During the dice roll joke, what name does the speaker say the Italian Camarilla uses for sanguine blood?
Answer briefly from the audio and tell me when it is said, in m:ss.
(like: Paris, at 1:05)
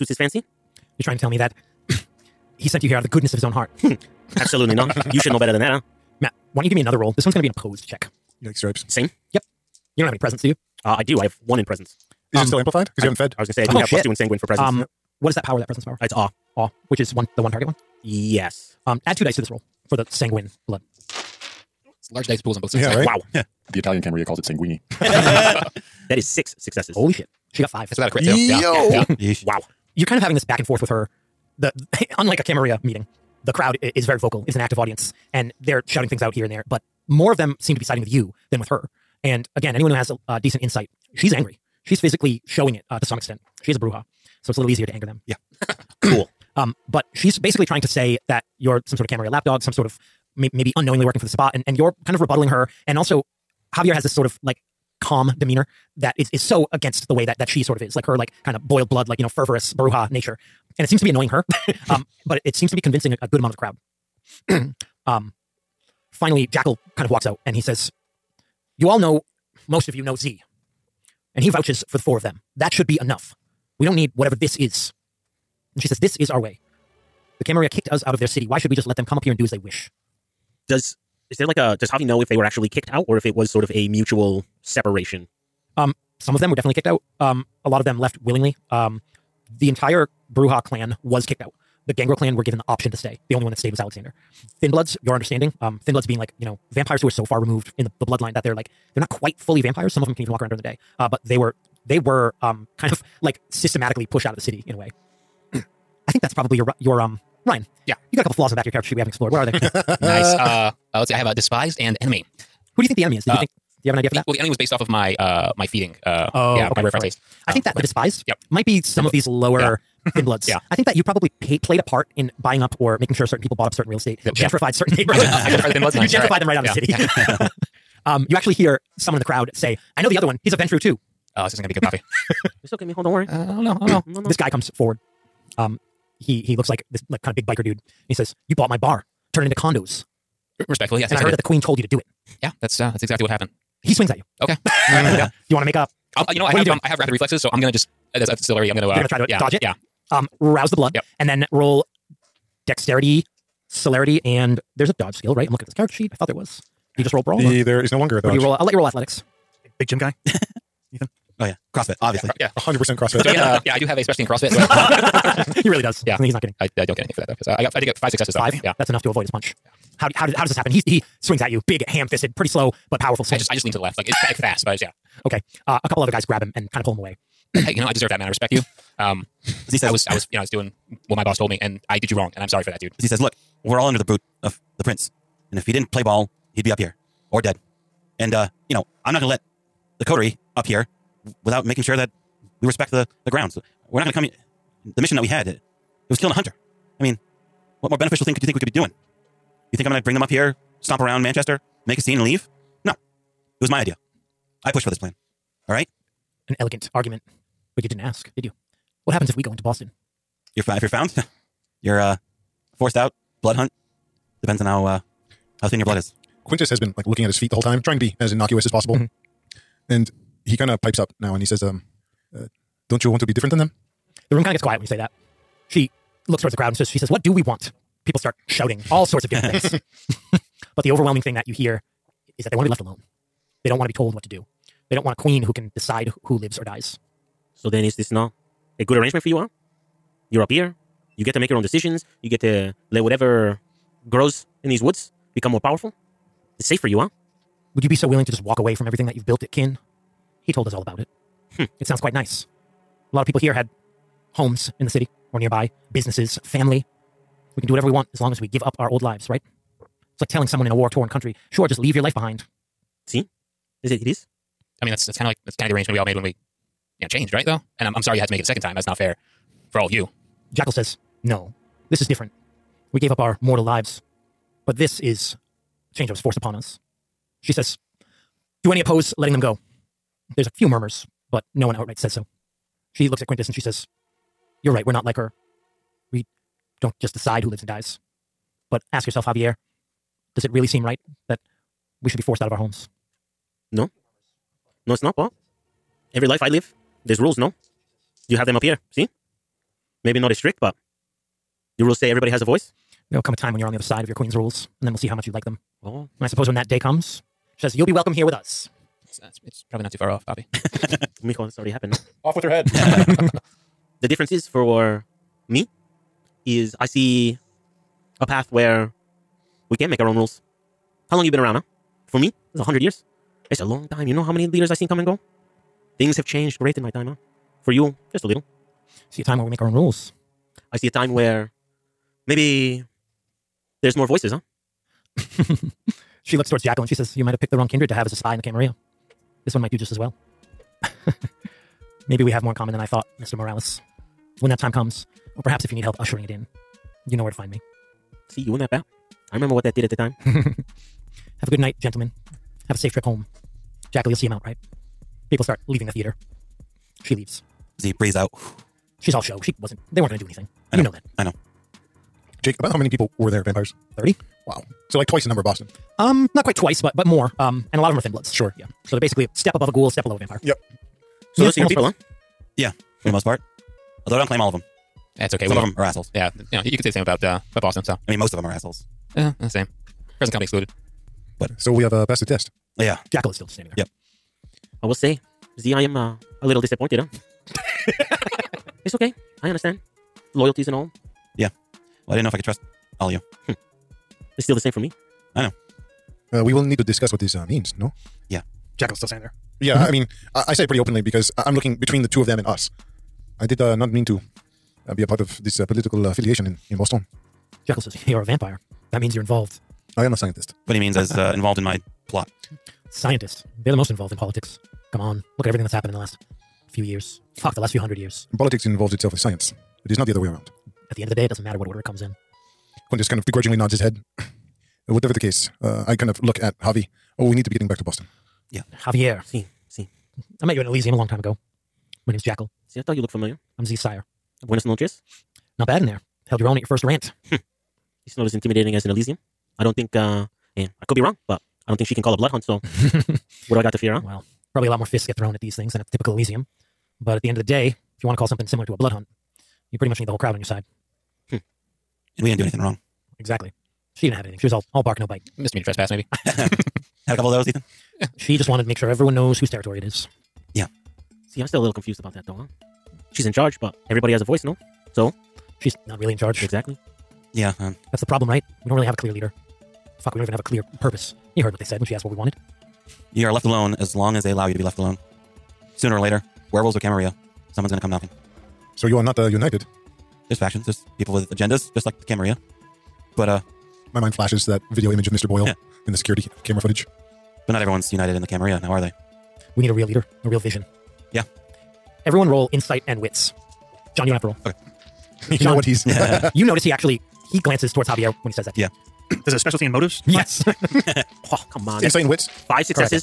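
sanguini, at 0:24.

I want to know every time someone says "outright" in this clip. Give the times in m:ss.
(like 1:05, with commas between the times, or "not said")
4:41.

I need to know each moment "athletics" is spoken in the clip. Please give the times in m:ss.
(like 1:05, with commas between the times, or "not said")
2:38.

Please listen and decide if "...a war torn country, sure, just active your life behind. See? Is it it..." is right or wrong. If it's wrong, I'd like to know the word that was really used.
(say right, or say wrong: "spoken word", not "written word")
wrong: "leave", not "active".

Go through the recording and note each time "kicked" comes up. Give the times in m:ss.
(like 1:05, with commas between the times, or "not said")
1:17, 1:22, 1:26, 1:31.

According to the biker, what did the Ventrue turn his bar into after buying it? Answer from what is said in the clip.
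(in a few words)
condos.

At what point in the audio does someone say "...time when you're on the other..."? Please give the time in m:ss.
5:03.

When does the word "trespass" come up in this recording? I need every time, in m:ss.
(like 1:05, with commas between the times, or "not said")
7:35.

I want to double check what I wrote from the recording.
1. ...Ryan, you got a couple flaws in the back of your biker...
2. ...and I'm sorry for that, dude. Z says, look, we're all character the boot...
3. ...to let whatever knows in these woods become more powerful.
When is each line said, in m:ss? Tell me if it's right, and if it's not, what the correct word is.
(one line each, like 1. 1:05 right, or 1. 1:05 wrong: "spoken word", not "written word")
1. 1:47 wrong: "character", not "biker"
2. 3:02 wrong: "under", not "character"
3. 4:02 wrong: "grows", not "knows".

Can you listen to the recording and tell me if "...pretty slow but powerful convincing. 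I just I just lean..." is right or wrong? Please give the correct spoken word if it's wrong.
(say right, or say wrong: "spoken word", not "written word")
wrong: "swing", not "convincing".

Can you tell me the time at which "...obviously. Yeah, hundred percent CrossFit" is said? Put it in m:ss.
2:42.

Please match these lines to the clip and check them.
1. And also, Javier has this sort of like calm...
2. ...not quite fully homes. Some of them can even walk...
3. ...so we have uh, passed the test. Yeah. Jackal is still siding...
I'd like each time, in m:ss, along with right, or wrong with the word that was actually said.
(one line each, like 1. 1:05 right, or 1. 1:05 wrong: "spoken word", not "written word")
1. 0:52 right
2. 1:38 wrong: "vampires", not "homes"
3. 6:21 wrong: "standing", not "siding".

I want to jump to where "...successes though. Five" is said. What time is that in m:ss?
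2:48.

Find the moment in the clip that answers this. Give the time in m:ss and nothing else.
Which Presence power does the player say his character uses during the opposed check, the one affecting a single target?
0:16.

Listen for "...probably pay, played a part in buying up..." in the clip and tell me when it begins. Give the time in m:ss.
2:01.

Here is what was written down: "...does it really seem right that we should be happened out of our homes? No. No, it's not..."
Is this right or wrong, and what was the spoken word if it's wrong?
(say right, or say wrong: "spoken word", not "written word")
wrong: "forced", not "happened".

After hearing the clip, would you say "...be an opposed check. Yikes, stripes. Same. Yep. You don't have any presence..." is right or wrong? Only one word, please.
right.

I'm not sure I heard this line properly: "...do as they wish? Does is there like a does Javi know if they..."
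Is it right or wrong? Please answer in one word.
right.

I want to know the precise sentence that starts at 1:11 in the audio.
And he vouches for the four of them.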